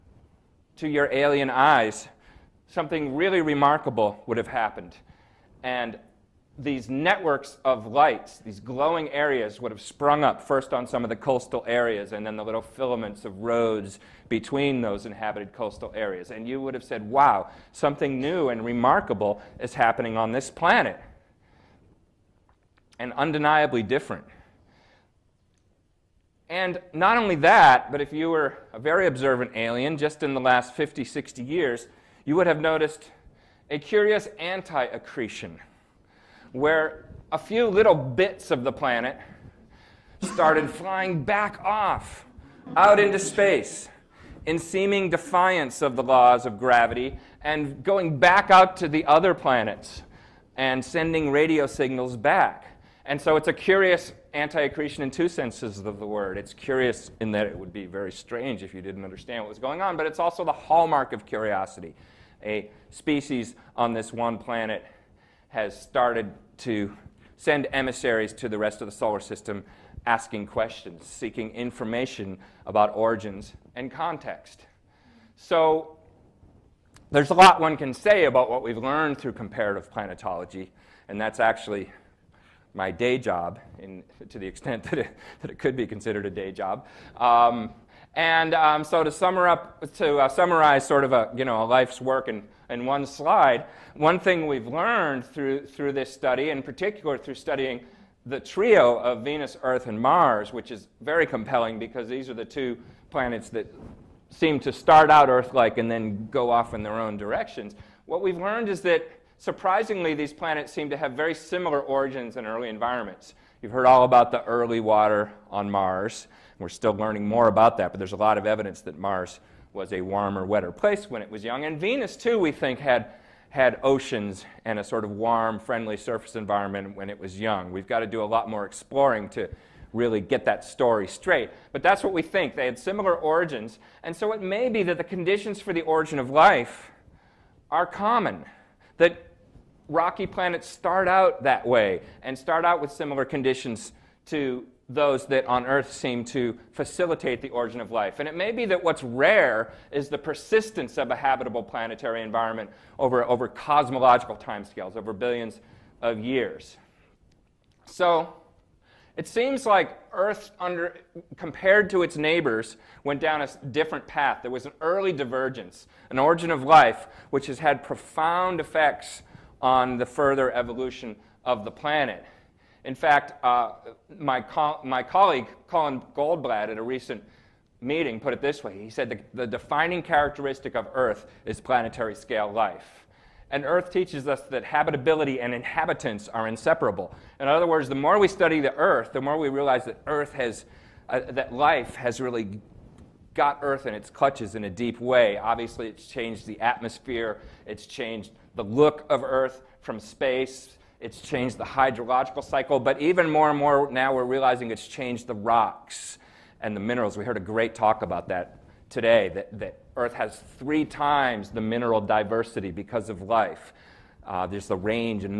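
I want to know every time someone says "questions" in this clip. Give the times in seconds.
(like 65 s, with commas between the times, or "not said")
70 s.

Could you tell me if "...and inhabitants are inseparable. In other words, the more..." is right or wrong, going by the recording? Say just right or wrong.
right.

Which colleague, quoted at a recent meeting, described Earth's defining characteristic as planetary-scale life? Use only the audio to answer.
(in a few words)
Colin Goldblatt.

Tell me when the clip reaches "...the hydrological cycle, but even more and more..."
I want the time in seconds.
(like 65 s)
201 s.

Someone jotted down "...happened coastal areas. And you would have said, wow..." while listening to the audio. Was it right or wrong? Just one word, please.
wrong.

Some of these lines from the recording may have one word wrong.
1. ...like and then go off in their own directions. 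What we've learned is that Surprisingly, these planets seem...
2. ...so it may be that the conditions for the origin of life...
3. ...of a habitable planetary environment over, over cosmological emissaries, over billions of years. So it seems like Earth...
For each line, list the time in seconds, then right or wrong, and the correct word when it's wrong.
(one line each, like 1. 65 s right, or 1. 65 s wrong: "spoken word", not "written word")
1. 105 s right
2. 134 s right
3. 150 s wrong: "timescales", not "emissaries".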